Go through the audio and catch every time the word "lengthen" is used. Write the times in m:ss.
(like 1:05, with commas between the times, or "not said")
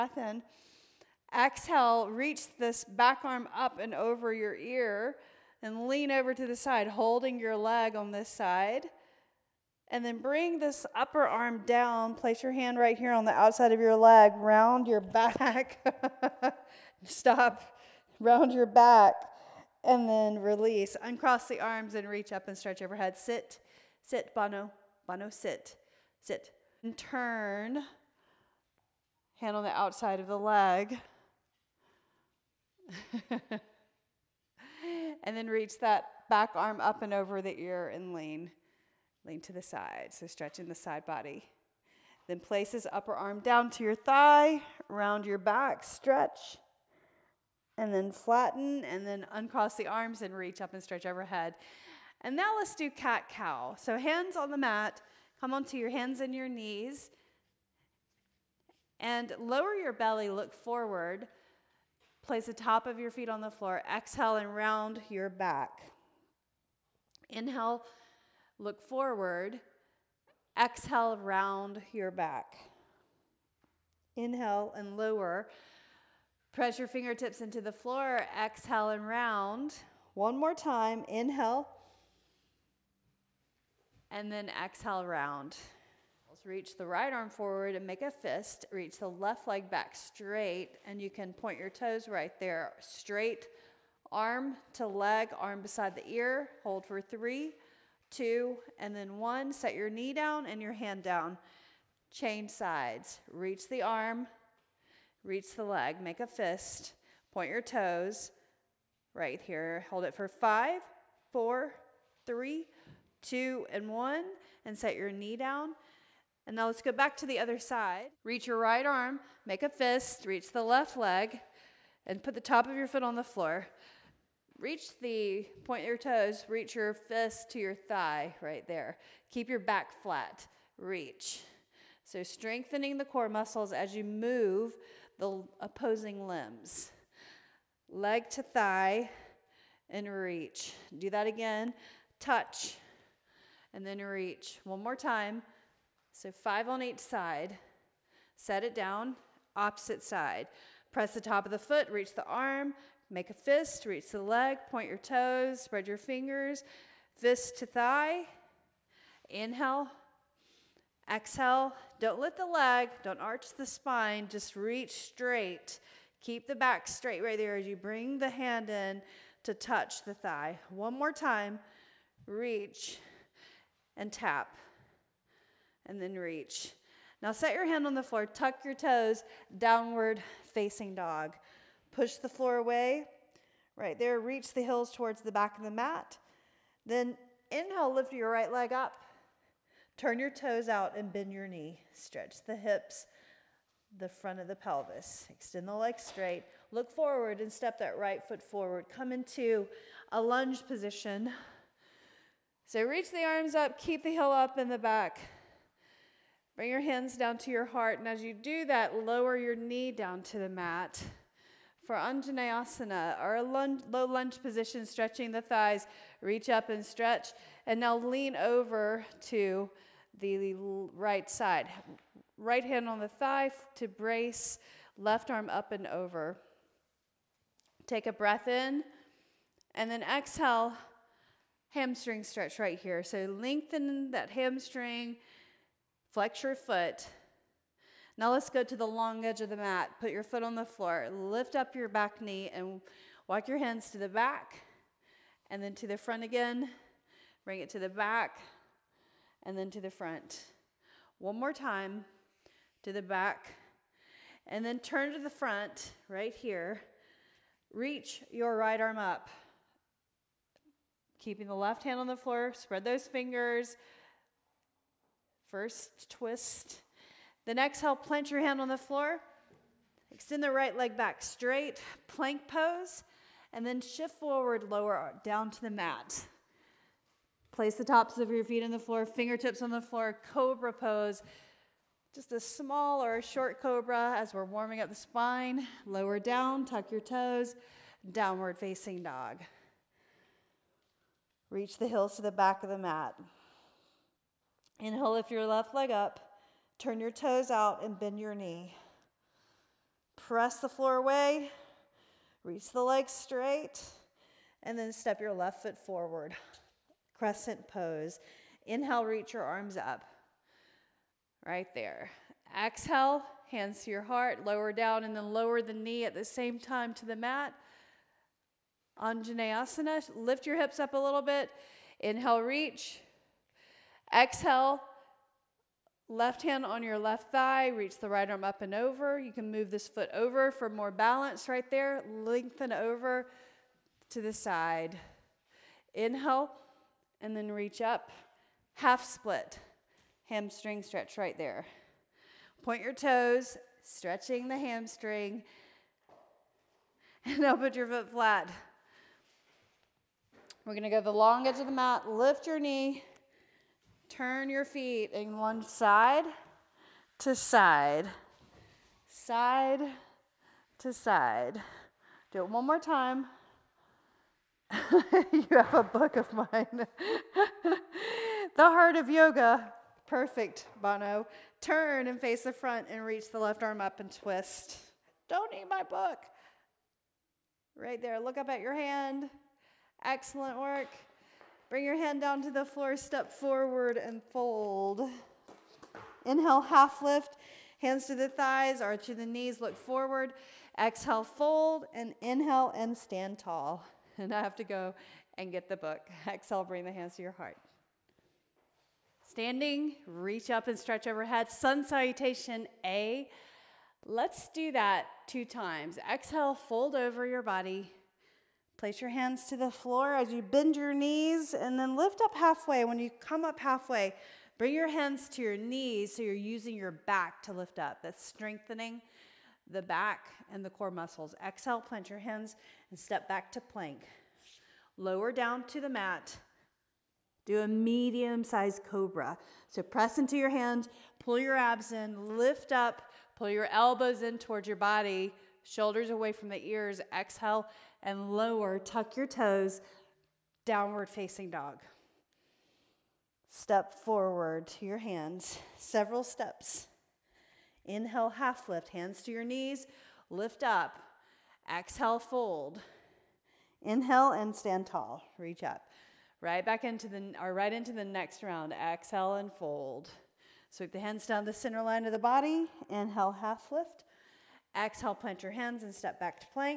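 3:53, 5:32.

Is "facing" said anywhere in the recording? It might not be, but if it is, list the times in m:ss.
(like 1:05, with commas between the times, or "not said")
3:00, 4:48, 7:21.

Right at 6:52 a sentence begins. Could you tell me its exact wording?
When you come up halfway, bring your hands to your knees so you're using your back to lift up.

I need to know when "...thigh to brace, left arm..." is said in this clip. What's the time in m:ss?
3:43.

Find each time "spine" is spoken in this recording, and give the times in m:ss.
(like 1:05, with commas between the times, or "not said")
2:43, 4:44.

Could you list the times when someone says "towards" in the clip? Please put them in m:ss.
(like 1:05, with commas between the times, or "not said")
3:04, 7:14.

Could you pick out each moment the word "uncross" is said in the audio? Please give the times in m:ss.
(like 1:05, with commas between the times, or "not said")
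0:21, 0:49.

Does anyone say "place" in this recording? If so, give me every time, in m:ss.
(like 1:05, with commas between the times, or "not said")
0:12, 0:42, 1:02, 4:37, 6:48.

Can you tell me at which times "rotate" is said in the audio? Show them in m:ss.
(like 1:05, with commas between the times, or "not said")
not said.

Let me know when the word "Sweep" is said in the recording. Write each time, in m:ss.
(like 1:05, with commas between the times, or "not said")
7:40.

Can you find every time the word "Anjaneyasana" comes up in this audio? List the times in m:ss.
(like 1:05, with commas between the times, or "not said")
3:31, 5:18.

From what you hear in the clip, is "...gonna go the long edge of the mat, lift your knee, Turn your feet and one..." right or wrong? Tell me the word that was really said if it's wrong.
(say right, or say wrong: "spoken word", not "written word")
right.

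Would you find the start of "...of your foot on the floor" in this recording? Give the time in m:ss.
2:02.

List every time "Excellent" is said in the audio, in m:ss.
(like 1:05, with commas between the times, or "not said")
6:20.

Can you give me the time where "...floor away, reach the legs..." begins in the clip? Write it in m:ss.
5:00.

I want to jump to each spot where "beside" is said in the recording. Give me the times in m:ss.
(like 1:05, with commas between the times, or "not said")
1:35.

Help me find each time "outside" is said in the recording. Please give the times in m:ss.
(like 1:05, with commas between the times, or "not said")
0:13, 0:29.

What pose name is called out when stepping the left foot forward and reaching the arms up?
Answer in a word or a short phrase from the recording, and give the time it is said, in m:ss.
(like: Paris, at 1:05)
Crescent pose, at 5:07.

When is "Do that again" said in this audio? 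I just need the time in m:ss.
2:20.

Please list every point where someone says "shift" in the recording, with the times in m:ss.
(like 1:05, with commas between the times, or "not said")
4:33.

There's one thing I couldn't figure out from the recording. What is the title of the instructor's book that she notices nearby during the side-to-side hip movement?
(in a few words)
The Heart of Yoga.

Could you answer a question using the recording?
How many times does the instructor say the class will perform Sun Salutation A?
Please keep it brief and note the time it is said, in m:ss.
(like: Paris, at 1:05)
2, at 6:45.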